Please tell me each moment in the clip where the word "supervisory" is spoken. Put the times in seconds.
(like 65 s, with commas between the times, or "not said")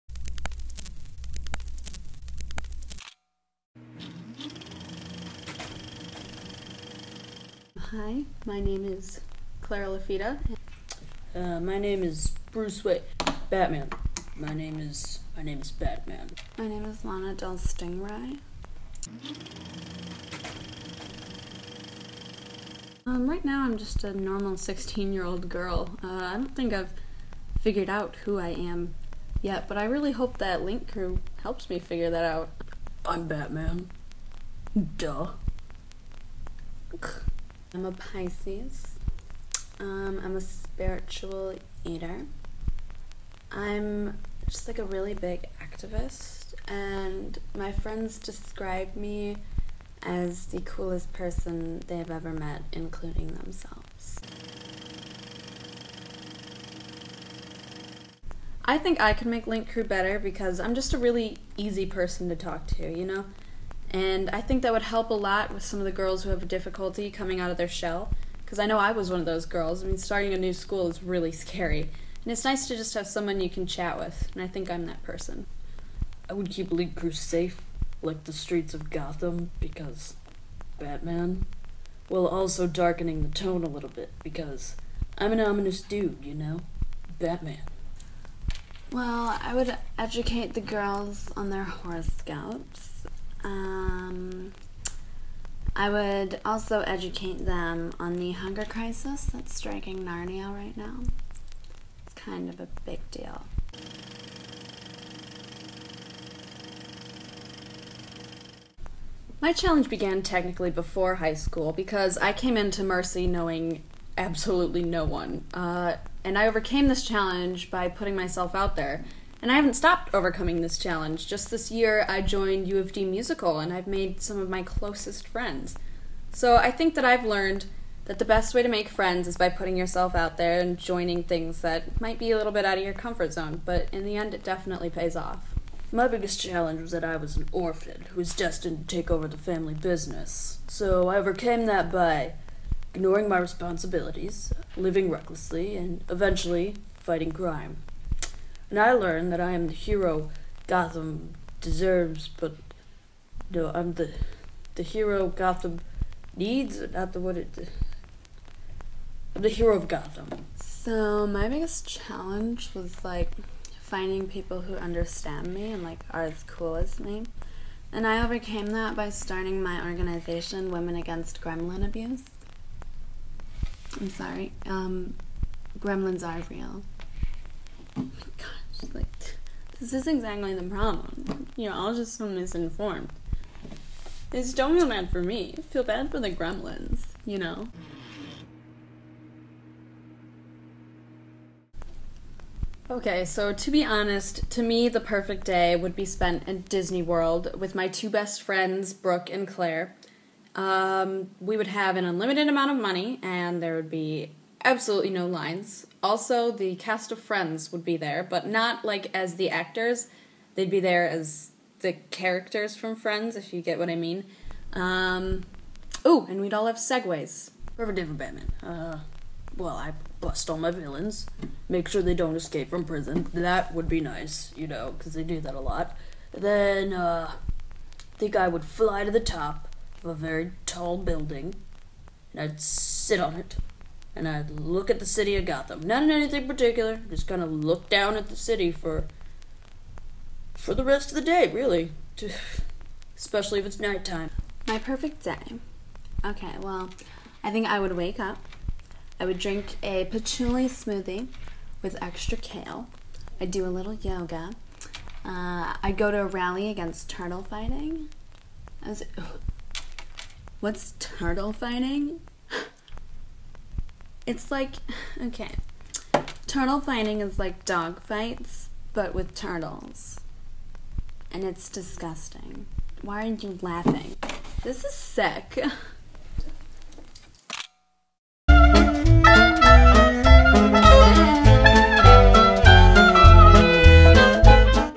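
not said.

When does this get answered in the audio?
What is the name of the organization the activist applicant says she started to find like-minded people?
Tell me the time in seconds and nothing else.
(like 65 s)
170 s.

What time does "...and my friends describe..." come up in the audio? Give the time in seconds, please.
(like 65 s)
46 s.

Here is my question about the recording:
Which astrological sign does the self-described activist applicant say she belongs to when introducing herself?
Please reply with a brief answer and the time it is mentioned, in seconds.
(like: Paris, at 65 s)
Pisces, at 37 s.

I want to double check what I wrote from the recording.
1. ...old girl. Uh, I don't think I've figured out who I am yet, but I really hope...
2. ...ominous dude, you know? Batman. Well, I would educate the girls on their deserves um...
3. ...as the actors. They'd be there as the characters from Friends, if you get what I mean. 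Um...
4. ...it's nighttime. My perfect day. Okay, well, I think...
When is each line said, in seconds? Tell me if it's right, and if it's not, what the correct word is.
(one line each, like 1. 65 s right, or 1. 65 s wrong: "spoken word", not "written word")
1. 25 s right
2. 85 s wrong: "horoscopes", not "deserves"
3. 209 s right
4. 243 s right.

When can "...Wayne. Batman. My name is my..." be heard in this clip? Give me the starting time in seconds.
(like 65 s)
12 s.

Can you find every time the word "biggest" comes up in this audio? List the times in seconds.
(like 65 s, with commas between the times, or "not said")
136 s, 161 s.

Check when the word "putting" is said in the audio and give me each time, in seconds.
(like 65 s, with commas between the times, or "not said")
117 s, 129 s.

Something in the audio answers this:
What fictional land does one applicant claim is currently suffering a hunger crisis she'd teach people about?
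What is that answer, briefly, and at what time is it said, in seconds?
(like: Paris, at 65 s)
Narnia, at 99 s.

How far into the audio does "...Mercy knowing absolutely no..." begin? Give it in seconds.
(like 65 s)
112 s.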